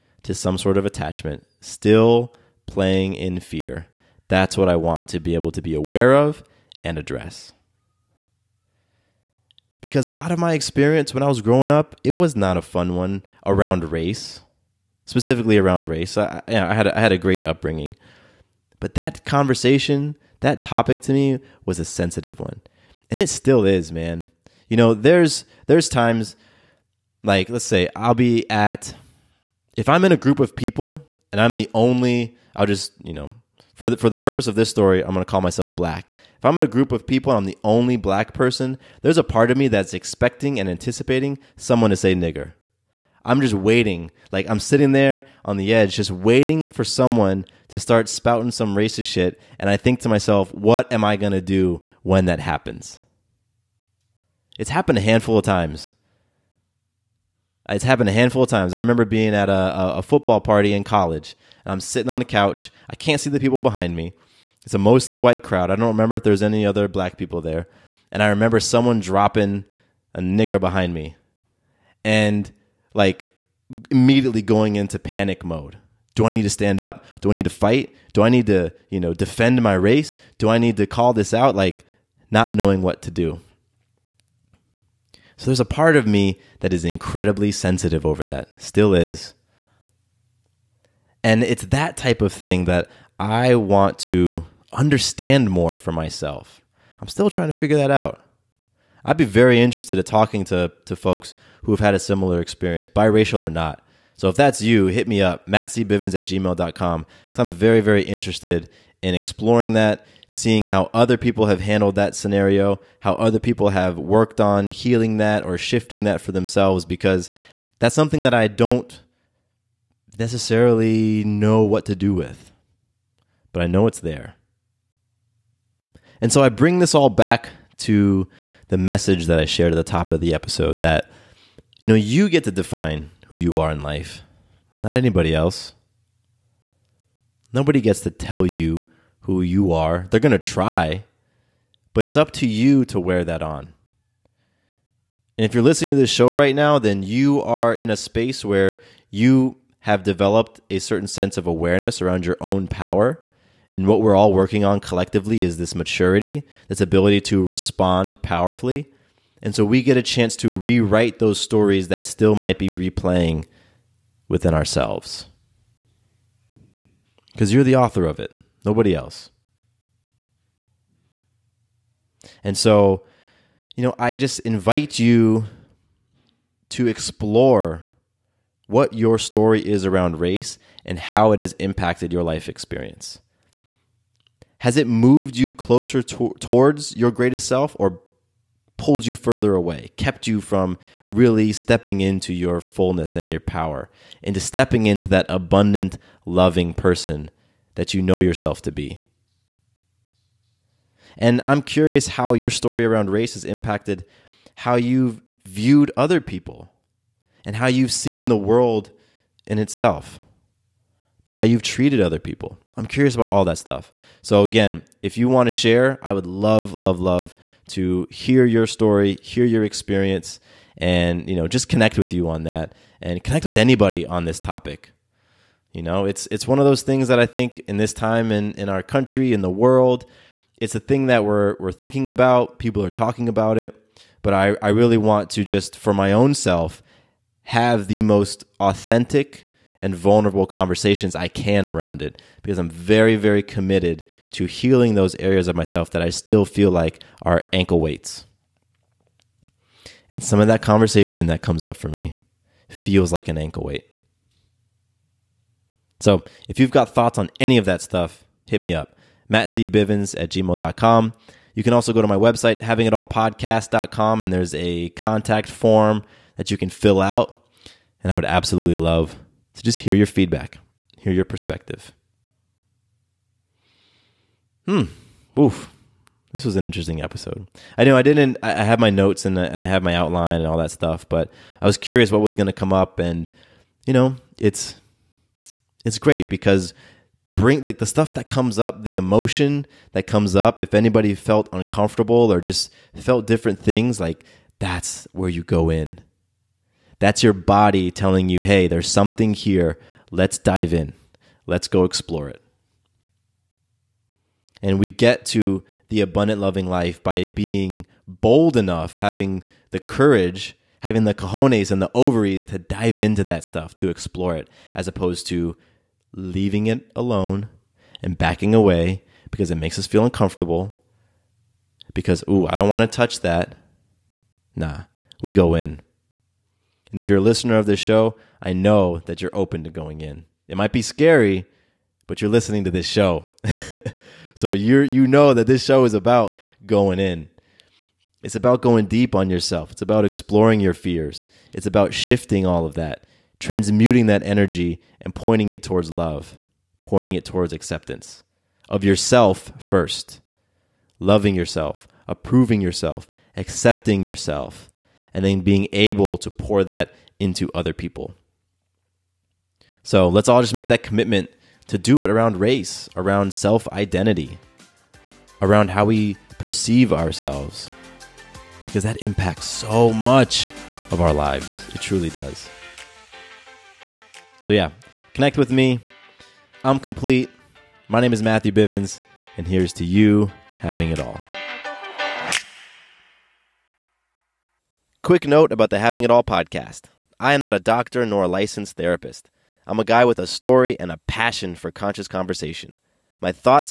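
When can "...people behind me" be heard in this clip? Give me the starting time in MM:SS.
01:03.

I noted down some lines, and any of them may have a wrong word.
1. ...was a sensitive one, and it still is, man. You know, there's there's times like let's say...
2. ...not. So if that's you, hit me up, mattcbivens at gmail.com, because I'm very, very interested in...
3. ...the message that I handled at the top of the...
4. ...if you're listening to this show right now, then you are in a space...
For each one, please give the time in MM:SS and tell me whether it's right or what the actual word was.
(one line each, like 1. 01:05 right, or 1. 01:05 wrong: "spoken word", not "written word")
1. 00:21 right
2. 01:43 right
3. 02:08 wrong: "shared", not "handled"
4. 02:25 right.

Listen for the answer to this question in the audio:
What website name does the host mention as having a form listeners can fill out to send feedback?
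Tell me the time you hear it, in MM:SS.
04:22.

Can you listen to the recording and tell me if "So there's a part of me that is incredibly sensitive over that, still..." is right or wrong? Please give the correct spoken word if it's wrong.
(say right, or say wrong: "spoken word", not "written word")
right.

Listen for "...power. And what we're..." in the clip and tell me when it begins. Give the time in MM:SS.
02:32.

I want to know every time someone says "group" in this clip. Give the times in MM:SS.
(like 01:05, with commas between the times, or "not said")
00:30, 00:36.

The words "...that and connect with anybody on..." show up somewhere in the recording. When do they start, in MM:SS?
03:42.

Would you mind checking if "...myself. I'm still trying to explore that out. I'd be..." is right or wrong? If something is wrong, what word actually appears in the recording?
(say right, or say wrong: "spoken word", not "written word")
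wrong: "figure", not "explore".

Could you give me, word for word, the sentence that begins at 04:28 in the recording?
And I would absolutely love to just hear your feedback, hear your perspective.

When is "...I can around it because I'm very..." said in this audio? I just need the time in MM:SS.
04:01.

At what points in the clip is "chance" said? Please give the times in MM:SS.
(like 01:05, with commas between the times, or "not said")
02:40.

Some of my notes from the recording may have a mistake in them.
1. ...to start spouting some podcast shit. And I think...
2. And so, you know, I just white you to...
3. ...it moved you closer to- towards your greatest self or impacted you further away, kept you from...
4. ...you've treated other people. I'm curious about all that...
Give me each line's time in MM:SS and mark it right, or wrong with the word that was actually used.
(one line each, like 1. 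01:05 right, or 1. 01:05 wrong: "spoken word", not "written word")
1. 00:47 wrong: "racist", not "podcast"
2. 02:52 wrong: "invite", not "white"
3. 03:04 wrong: "pulled", not "impacted"
4. 03:31 right.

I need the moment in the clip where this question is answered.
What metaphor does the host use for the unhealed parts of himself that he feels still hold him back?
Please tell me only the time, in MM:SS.
04:07.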